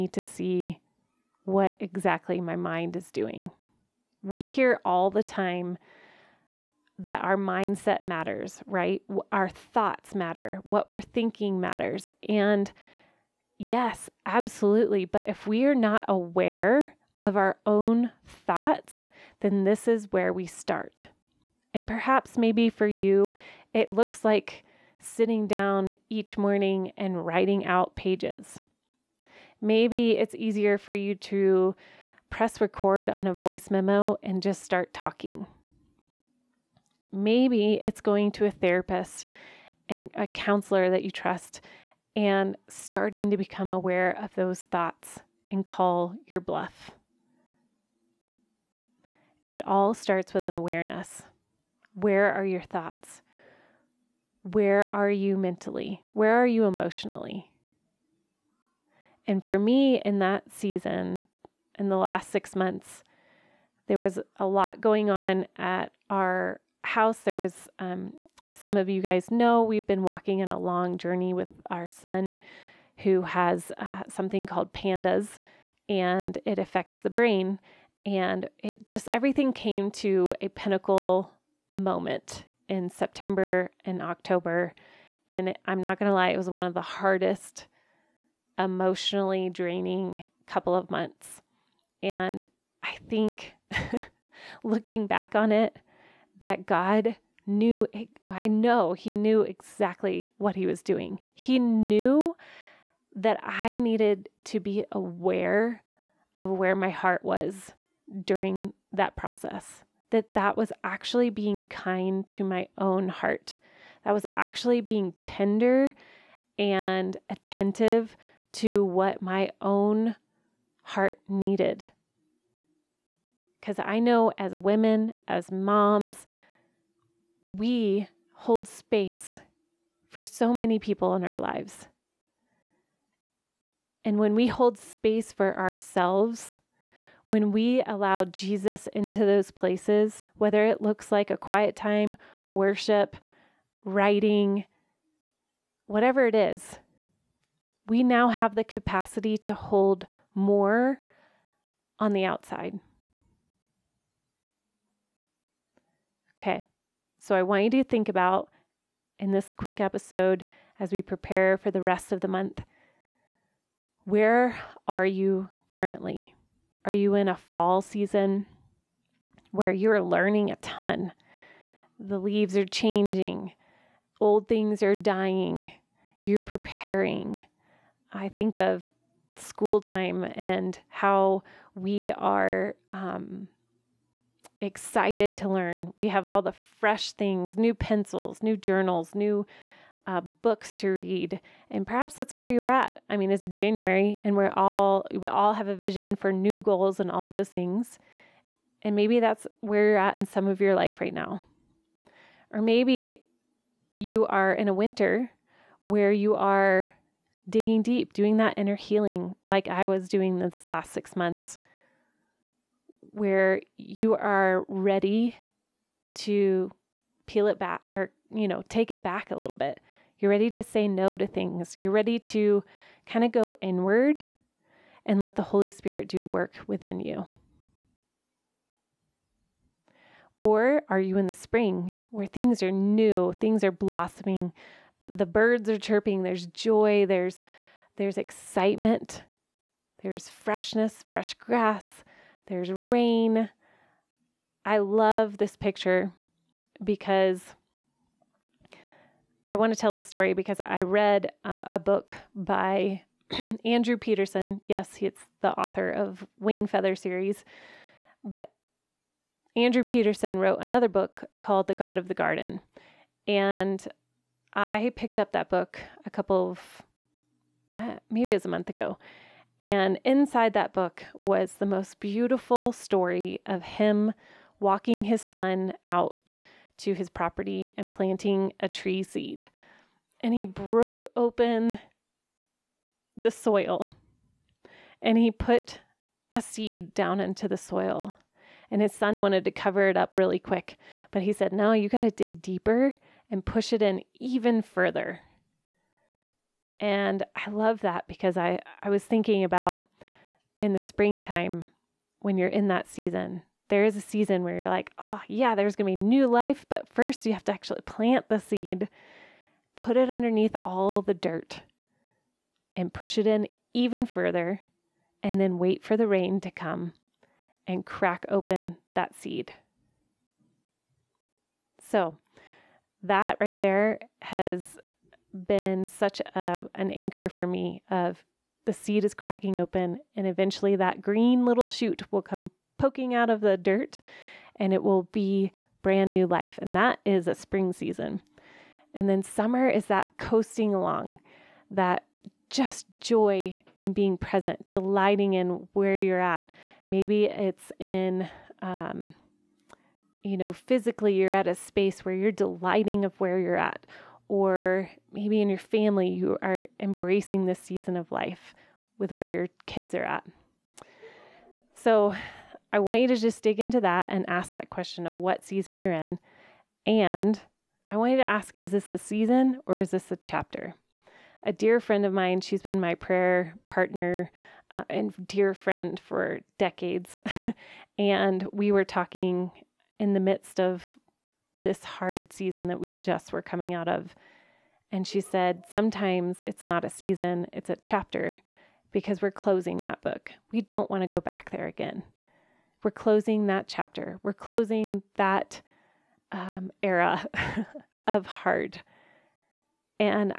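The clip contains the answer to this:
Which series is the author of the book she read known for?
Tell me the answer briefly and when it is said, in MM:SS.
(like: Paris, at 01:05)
Wing Feather series, at 04:16.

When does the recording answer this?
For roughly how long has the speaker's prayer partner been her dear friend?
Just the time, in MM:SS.
06:16.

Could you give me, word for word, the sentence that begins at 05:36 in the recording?
And that is a spring season.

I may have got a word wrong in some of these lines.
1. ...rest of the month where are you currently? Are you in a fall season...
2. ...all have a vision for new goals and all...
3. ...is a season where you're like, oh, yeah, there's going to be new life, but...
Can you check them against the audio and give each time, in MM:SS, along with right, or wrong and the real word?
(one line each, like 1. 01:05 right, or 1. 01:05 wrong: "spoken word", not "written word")
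1. 02:41 right
2. 03:15 right
3. 05:03 right.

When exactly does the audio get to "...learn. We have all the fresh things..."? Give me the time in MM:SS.
03:05.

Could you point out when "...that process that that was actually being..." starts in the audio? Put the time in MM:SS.
01:48.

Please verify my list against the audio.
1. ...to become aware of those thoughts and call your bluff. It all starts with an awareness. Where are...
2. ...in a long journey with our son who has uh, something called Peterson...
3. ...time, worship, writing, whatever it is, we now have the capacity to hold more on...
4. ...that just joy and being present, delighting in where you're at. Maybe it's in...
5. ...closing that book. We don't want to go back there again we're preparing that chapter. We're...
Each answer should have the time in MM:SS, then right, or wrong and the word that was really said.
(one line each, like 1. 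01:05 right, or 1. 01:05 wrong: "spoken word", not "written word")
1. 00:43 right
2. 01:10 wrong: "PANDAS", not "Peterson"
3. 02:21 right
4. 05:41 right
5. 06:29 wrong: "closing", not "preparing".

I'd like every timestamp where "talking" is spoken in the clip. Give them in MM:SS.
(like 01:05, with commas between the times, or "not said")
00:34, 06:18.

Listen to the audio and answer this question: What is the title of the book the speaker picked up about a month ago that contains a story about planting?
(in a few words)
The God of the Garden.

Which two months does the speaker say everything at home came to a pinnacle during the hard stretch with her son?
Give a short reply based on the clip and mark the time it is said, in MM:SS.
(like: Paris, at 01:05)
September and October, at 01:22.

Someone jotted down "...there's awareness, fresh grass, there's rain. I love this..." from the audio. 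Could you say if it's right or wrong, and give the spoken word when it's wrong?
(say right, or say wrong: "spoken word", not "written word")
wrong: "freshness", not "awareness".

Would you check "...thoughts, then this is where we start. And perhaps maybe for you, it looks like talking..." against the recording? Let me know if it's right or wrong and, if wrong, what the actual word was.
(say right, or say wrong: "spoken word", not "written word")
wrong: "sitting", not "talking".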